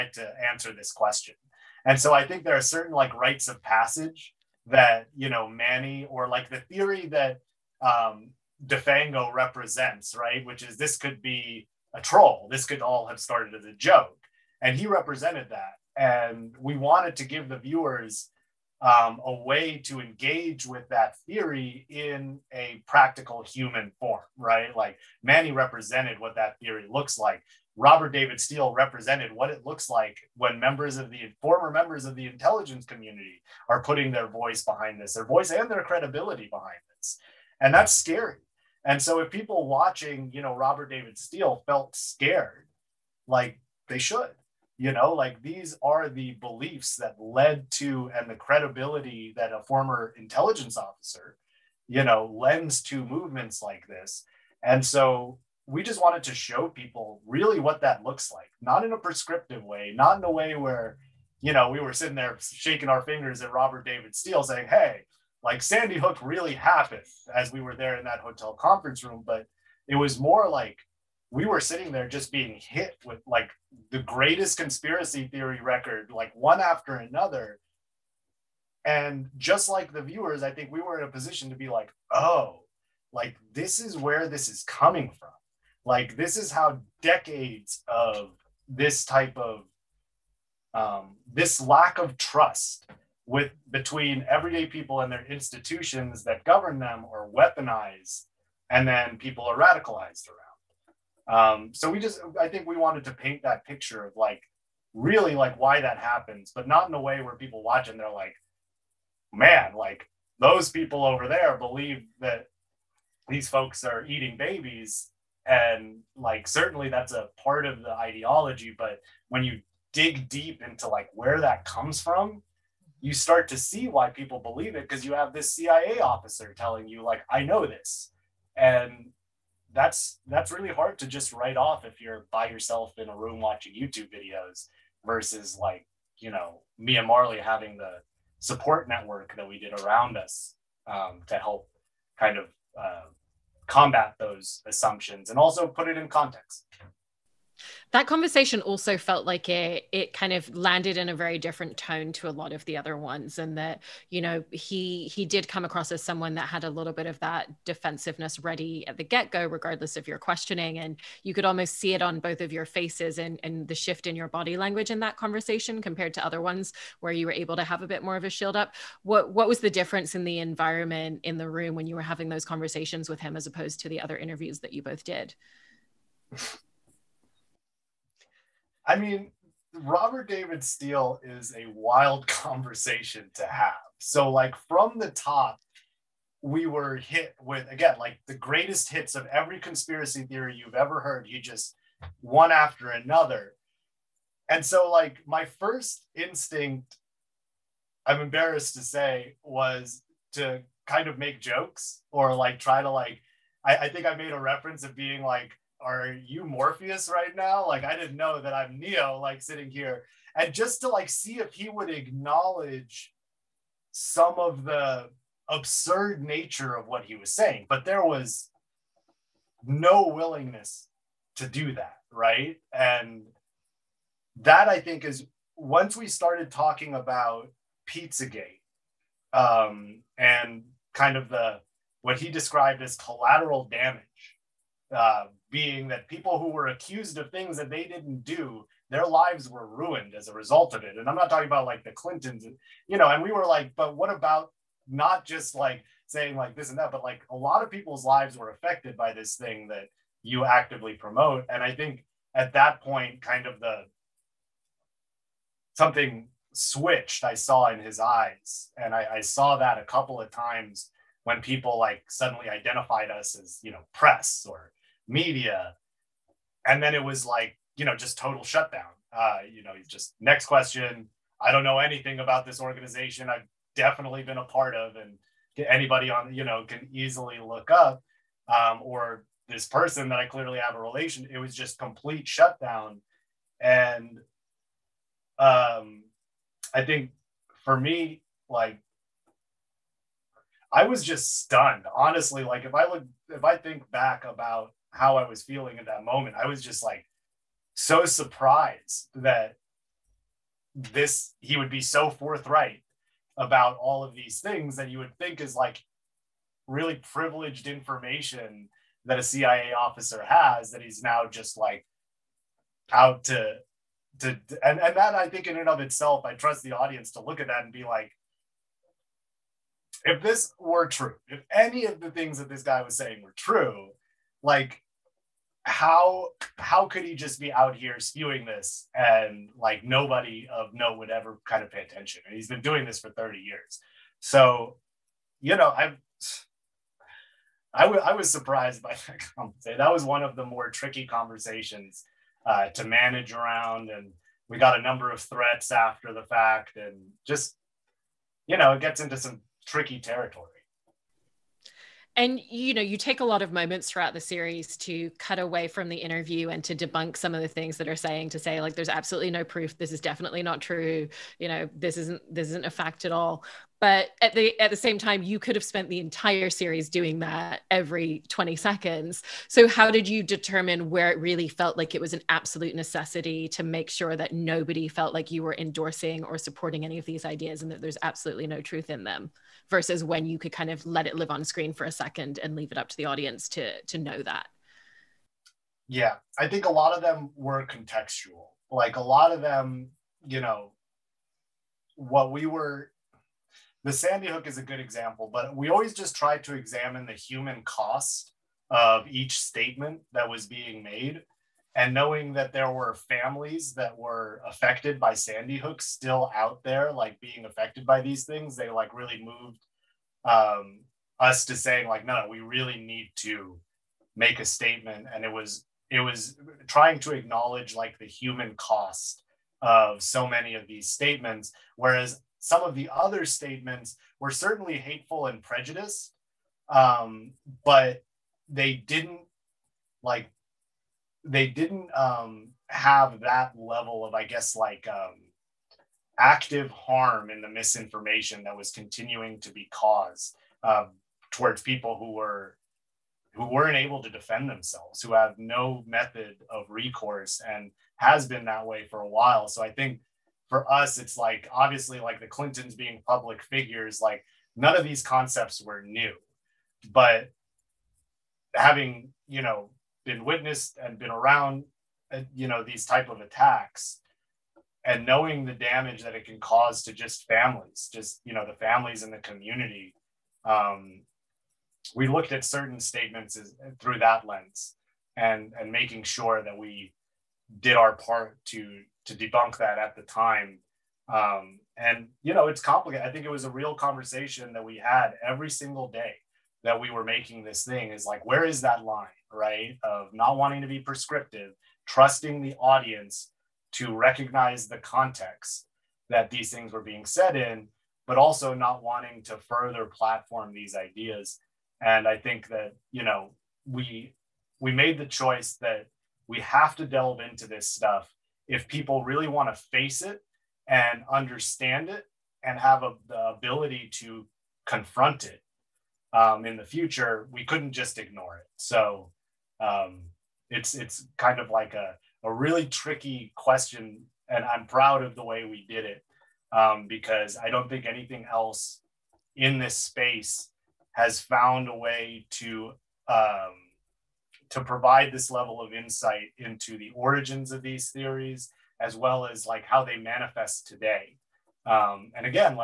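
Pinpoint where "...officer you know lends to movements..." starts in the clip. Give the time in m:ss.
0:50.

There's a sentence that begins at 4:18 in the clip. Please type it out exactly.
And I, I saw that a couple of times when people like suddenly identified us as, you know, press or media.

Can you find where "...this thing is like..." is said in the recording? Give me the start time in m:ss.
8:07.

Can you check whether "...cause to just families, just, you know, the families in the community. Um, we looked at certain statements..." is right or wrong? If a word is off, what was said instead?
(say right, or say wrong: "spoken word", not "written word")
right.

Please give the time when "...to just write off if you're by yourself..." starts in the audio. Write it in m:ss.
2:10.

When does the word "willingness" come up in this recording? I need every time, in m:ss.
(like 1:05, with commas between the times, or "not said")
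3:40.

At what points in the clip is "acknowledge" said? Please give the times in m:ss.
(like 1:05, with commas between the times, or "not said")
3:31, 6:57.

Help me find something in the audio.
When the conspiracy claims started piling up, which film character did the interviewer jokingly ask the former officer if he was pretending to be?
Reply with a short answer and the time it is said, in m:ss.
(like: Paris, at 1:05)
Morpheus, at 3:26.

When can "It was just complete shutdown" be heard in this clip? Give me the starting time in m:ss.
4:41.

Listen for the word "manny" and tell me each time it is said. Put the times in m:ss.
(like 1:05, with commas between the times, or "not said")
0:05, 0:25.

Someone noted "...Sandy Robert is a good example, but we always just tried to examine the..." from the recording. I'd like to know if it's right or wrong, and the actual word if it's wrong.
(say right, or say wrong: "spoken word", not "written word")
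wrong: "Hook", not "Robert".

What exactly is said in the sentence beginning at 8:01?
Um, and you know, it's complicated.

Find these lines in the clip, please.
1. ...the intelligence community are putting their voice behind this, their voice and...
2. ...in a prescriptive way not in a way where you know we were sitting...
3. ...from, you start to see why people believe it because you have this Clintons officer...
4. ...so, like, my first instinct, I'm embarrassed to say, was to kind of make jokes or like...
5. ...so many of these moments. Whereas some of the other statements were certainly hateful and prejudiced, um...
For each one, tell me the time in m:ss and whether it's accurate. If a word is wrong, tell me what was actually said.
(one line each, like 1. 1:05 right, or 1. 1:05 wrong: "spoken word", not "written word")
1. 0:32 right
2. 0:58 right
3. 2:02 wrong: "CIA", not "Clintons"
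4. 3:14 right
5. 7:00 wrong: "statements", not "moments".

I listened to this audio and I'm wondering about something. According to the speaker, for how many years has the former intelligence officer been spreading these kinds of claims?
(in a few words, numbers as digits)
30 years.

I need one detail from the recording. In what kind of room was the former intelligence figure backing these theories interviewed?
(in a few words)
hotel conference room.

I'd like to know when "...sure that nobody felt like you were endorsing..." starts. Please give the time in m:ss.
6:13.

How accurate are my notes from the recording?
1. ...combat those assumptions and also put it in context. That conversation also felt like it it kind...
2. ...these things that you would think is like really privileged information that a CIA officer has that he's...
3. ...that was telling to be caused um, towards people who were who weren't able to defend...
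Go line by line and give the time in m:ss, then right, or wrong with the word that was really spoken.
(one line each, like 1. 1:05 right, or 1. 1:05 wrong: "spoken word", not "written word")
1. 2:23 right
2. 5:04 right
3. 7:18 wrong: "continuing", not "telling".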